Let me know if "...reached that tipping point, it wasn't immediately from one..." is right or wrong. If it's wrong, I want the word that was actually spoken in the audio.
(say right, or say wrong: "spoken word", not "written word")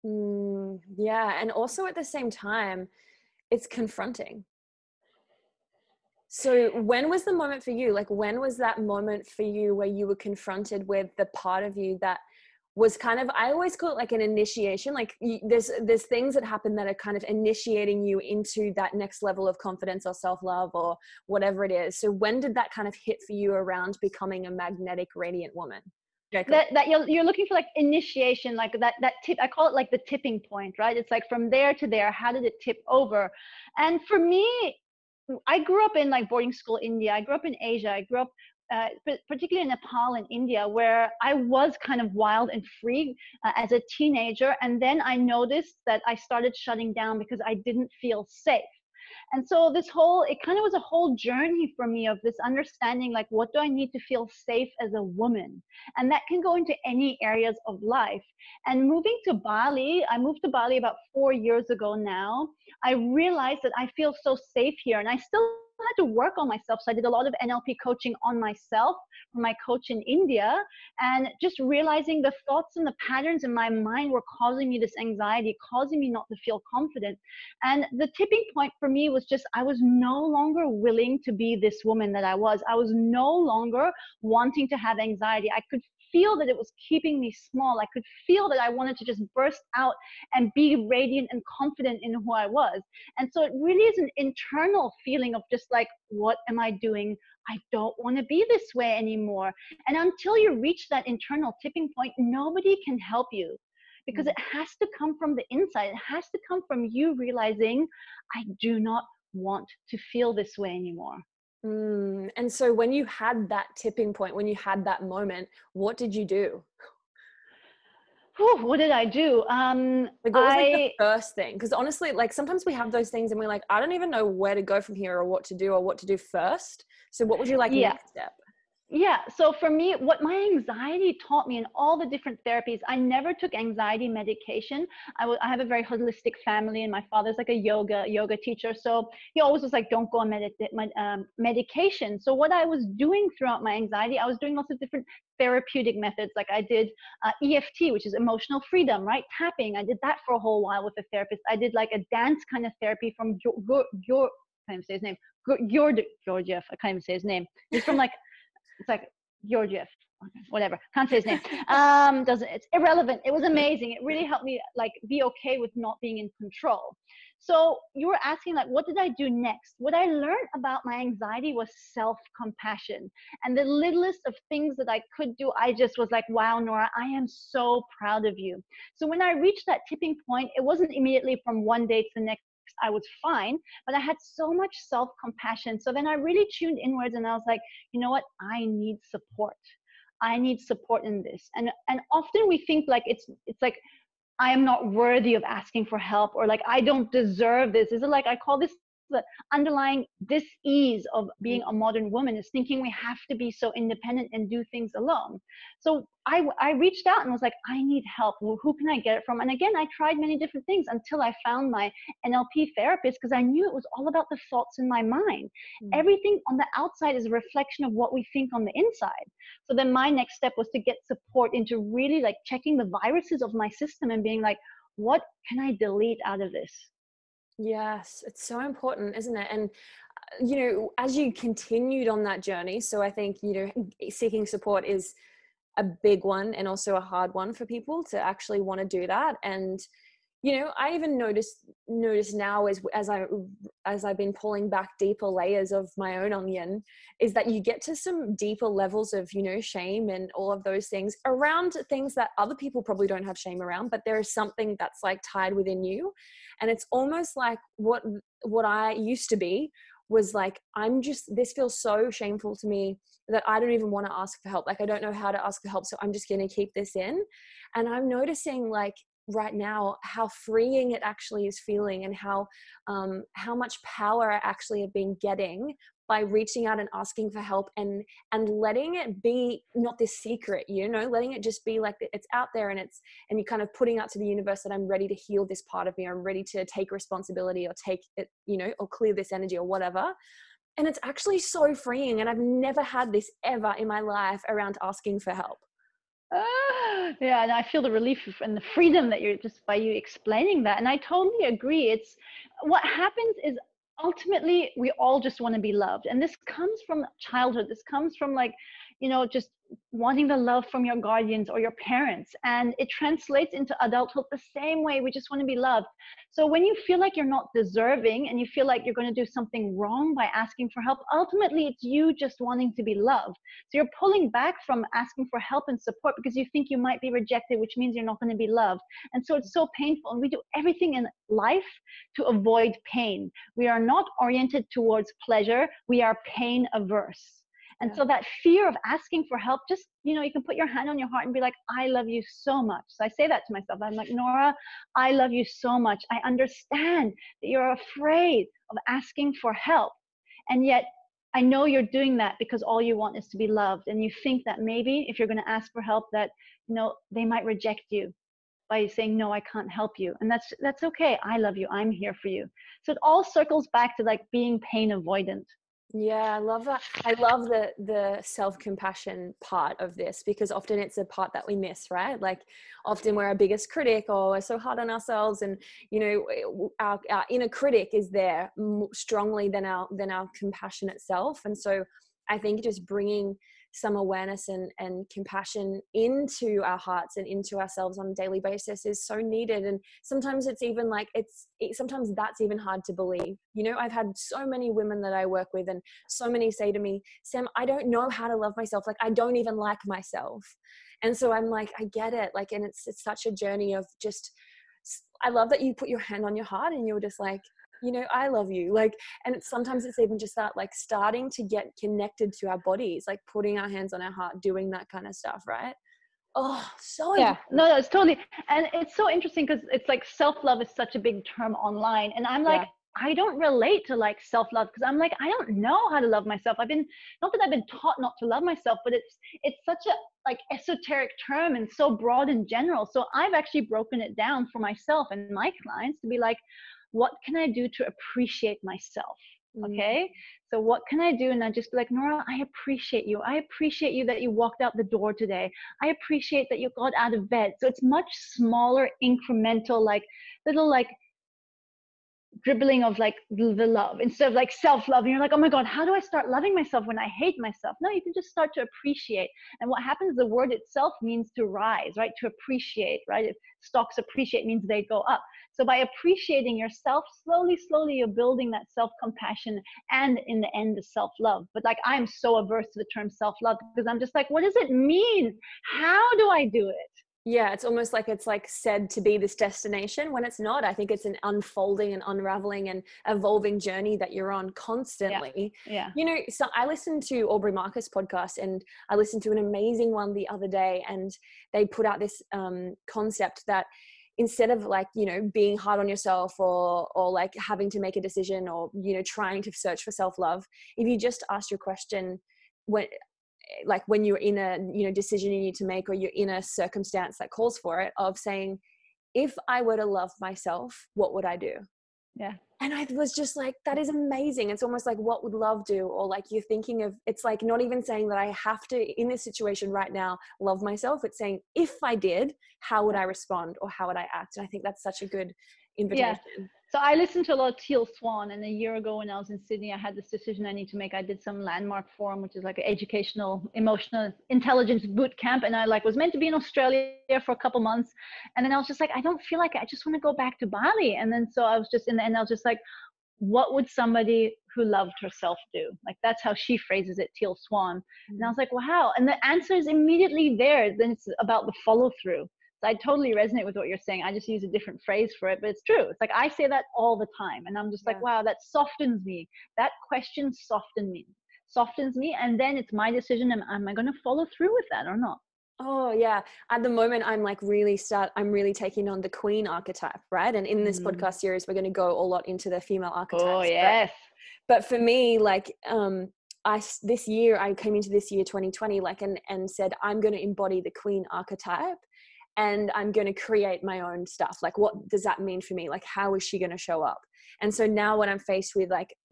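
right.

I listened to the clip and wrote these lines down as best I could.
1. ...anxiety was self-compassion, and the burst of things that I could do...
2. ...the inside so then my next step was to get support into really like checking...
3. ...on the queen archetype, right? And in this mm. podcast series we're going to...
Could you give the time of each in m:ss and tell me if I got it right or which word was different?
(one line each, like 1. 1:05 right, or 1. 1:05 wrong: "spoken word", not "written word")
1. 2:50 wrong: "littlest", not "burst"
2. 3:38 right
3. 9:28 right.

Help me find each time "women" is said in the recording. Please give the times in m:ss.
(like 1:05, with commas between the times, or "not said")
6:34.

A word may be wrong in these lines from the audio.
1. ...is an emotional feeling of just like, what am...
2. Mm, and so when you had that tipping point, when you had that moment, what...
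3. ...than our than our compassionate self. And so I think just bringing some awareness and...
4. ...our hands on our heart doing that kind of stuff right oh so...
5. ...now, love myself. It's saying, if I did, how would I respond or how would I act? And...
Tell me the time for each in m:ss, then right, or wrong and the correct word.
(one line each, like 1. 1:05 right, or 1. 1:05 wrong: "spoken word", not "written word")
1. 1:33 wrong: "internal", not "emotional"
2. 1:51 right
3. 6:19 right
4. 6:53 right
5. 8:39 right.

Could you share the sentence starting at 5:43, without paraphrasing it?
I'm like, Nora, I love you so much.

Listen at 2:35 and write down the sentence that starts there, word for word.
Georgia, Georgiev, I can't even say his name.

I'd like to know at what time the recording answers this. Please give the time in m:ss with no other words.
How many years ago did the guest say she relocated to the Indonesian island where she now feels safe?
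1:01.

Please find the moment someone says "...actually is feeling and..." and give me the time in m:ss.
4:31.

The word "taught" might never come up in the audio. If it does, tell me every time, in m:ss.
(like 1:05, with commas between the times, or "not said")
2:11, 7:07.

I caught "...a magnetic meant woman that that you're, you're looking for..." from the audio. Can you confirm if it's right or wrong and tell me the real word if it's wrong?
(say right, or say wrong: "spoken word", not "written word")
wrong: "radiant", not "meant".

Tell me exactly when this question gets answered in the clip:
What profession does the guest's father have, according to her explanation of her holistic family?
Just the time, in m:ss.
2:18.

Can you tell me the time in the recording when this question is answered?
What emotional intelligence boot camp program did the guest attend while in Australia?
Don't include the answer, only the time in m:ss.
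8:51.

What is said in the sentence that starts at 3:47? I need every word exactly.
Yes, it's so important, isn't it?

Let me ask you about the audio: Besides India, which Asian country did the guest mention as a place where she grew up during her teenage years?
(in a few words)
Nepal.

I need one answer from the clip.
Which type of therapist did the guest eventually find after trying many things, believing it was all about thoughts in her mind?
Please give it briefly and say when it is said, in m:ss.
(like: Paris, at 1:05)
NLP therapist, at 3:32.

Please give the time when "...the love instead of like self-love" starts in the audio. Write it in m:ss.
7:33.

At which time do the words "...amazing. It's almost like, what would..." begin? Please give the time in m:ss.
8:33.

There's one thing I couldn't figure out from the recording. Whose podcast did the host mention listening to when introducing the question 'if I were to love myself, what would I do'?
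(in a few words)
Aubrey Marcus.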